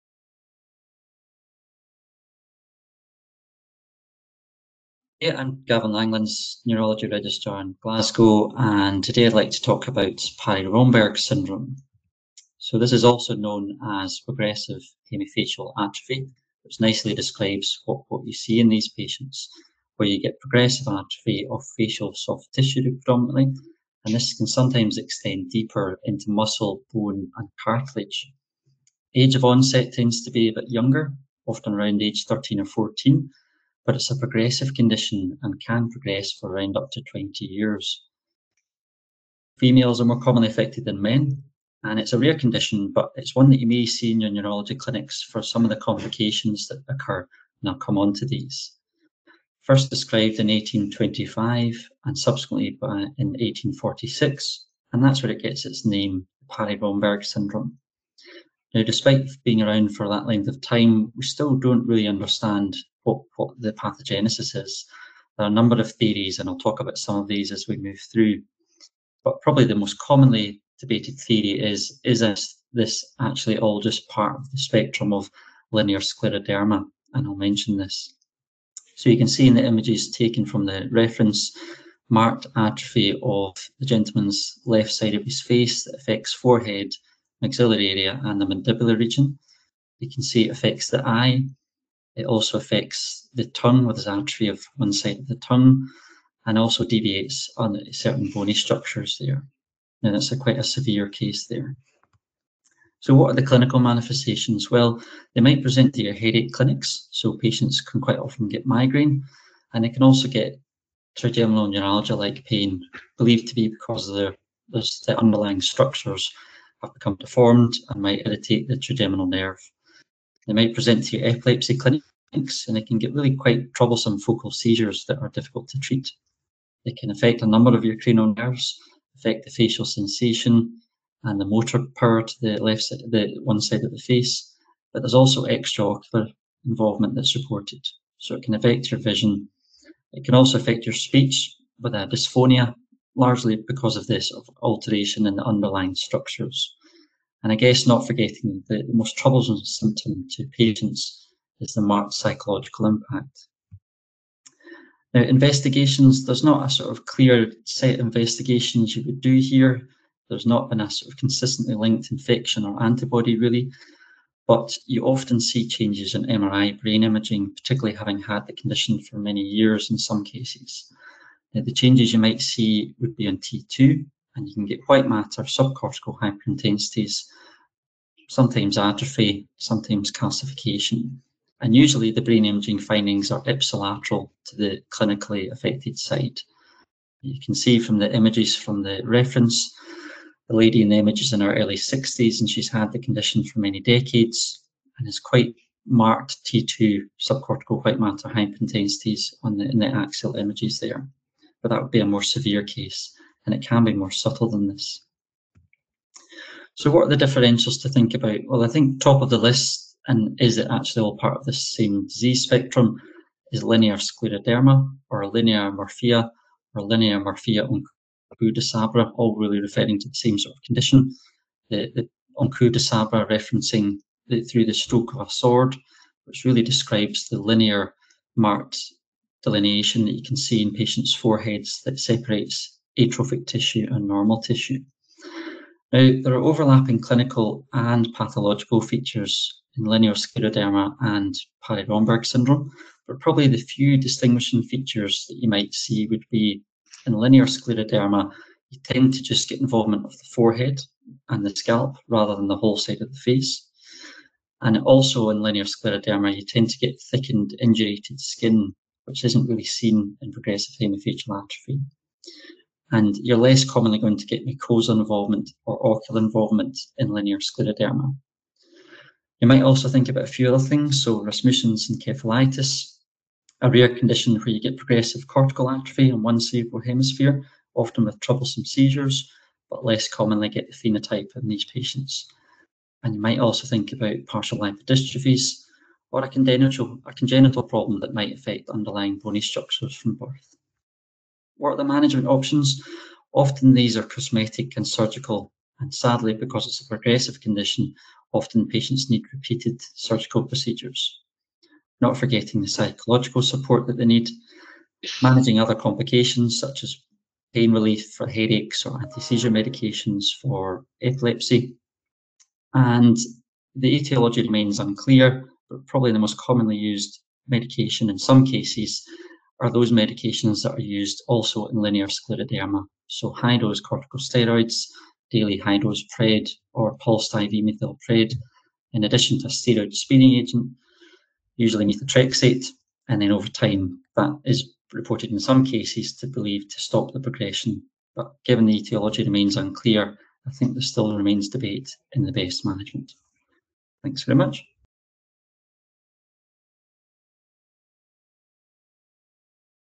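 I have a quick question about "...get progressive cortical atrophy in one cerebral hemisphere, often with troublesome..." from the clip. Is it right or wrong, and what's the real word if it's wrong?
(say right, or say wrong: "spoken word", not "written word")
right.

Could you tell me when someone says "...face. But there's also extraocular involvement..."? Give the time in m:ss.
2:13.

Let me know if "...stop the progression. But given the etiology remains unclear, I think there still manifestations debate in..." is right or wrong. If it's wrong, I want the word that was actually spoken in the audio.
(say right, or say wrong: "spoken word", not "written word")
wrong: "remains", not "manifestations".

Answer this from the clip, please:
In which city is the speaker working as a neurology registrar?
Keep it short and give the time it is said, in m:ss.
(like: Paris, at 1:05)
Glasgow, at 0:07.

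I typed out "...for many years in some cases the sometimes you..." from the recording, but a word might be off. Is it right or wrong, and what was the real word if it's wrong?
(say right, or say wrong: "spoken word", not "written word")
wrong: "changes", not "sometimes".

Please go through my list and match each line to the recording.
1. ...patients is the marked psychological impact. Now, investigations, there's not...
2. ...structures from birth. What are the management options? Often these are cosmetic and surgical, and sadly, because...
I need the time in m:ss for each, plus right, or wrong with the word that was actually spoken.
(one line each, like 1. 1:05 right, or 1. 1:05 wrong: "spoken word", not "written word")
1. 2:30 right
2. 4:49 right.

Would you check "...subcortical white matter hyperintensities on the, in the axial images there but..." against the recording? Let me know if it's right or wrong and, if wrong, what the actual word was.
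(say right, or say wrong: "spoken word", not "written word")
right.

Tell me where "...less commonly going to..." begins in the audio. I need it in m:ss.
4:23.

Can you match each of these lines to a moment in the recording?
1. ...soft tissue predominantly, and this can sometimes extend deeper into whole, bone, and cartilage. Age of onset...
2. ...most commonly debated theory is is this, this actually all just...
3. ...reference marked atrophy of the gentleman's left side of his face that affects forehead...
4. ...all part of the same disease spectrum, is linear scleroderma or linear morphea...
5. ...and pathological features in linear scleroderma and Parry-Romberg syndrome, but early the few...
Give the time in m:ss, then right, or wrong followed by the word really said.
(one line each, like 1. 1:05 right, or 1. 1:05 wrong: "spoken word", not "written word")
1. 0:22 wrong: "muscle", not "whole"
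2. 1:09 right
3. 1:20 right
4. 3:31 right
5. 3:57 wrong: "probably", not "early".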